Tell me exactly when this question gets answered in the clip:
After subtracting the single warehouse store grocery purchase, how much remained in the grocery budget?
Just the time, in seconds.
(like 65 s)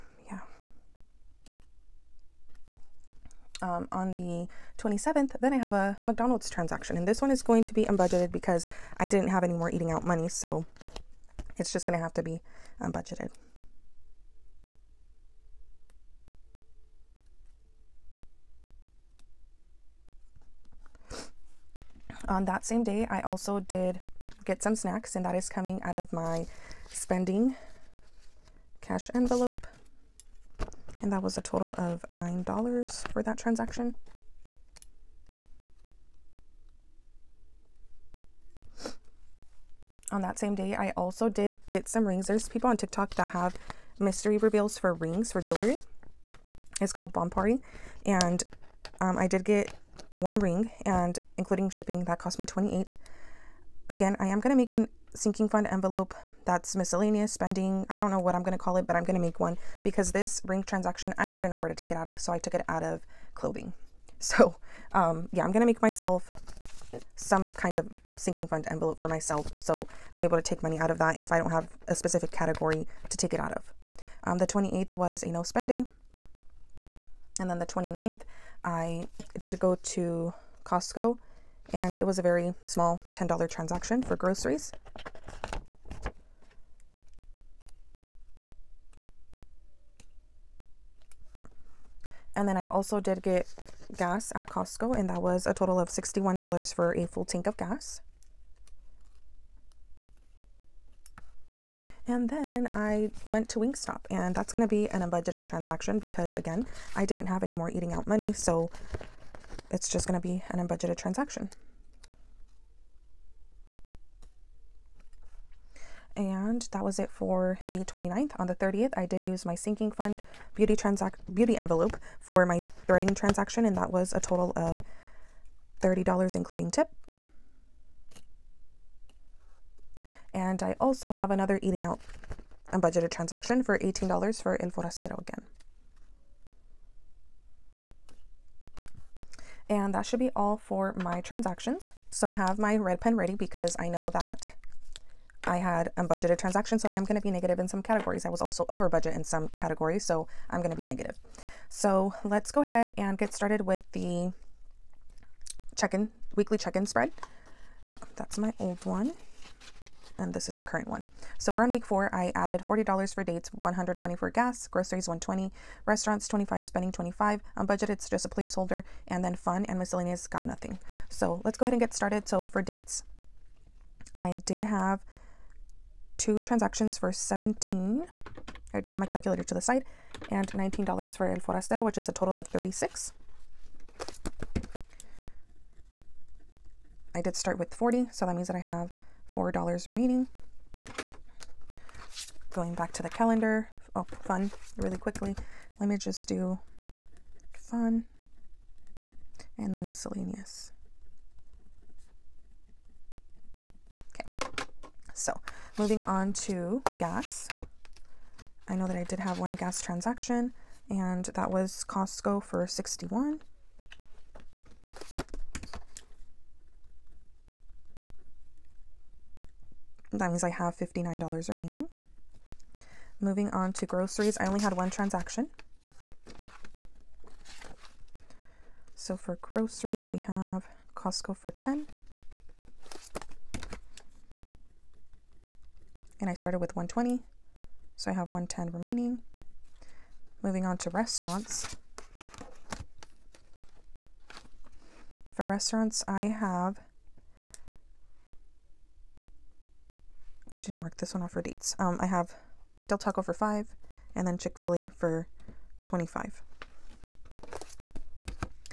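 238 s.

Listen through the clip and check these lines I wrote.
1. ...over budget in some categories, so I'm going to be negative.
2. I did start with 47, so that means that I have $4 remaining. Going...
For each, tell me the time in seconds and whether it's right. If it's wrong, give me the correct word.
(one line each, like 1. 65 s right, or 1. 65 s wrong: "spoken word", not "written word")
1. 148 s right
2. 187 s wrong: "40", not "47".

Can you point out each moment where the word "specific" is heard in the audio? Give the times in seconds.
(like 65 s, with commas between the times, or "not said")
71 s.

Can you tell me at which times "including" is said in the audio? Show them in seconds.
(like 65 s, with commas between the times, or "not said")
51 s, 126 s.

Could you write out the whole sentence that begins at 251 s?
Um, I have Del Taco for five, and then Chick Fil A for twenty-five.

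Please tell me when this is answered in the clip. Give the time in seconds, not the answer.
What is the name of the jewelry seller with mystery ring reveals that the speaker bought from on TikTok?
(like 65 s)
47 s.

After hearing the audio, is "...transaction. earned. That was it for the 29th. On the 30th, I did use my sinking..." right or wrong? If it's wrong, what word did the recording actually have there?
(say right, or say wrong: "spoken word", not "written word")
right.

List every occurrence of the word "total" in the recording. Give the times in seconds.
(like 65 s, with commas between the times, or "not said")
31 s, 95 s, 124 s, 182 s.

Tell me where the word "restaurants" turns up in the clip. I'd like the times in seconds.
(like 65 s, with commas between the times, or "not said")
165 s, 240 s, 245 s.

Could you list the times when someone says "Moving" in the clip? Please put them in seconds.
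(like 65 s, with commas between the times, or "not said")
205 s, 223 s, 240 s.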